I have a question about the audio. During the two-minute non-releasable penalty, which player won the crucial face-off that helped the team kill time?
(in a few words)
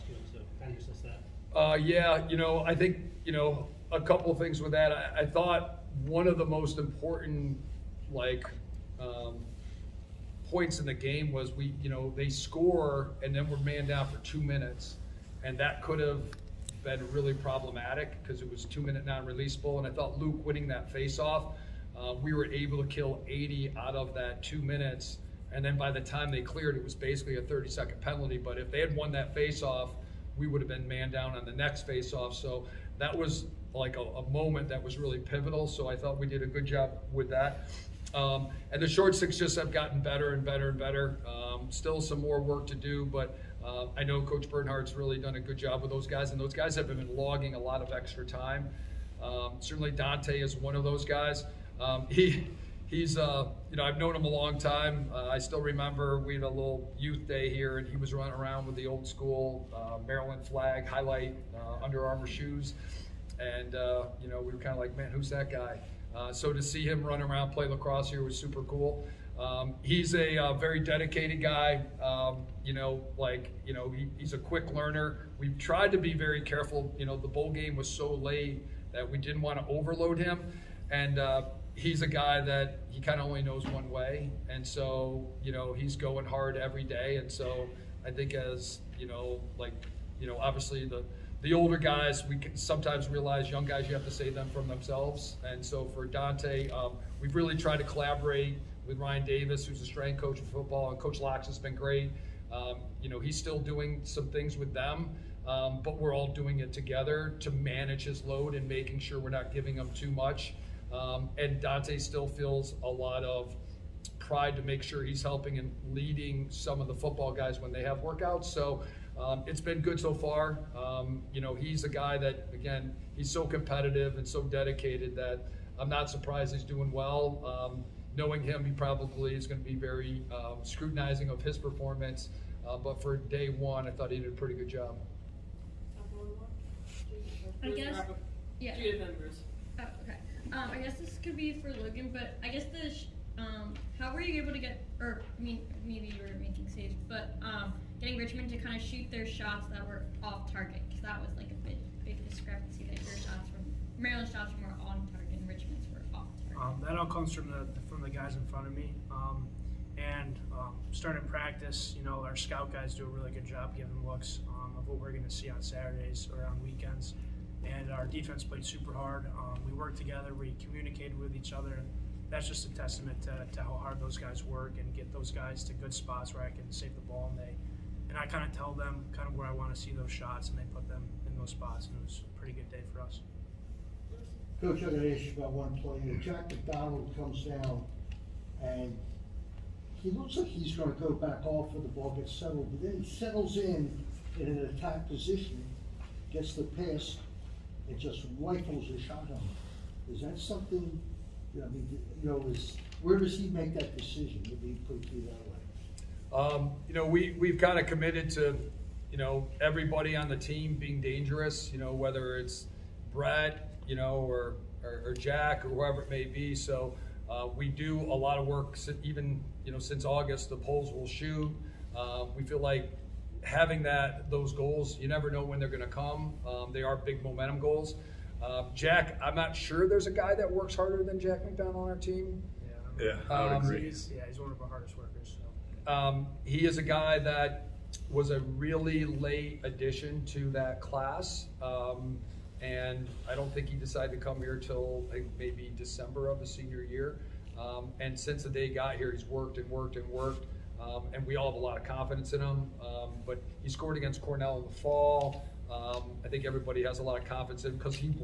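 Luke.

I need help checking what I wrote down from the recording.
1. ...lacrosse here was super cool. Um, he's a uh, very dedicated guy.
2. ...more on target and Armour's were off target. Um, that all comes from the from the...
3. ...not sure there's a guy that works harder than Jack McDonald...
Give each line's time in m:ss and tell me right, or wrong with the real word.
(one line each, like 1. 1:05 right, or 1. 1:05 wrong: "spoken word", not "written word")
1. 1:07 right
2. 2:34 wrong: "Richmond", not "Armour"
3. 3:49 right.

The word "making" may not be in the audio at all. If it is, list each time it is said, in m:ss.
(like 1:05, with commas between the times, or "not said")
1:48, 2:26.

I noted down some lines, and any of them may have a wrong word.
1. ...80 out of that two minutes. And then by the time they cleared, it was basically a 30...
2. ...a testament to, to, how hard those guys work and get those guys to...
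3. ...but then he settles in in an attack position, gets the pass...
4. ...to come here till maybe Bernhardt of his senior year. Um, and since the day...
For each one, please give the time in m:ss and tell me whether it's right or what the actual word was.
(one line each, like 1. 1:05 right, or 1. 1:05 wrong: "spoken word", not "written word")
1. 0:23 right
2. 2:52 right
3. 3:12 right
4. 4:04 wrong: "December", not "Bernhardt".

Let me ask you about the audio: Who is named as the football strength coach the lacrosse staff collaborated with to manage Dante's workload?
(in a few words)
Ryan Davis.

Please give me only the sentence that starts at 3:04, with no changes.
Coach, I got an issue about one player.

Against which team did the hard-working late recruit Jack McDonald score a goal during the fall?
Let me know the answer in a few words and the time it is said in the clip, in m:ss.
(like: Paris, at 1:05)
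Cornell, at 4:14.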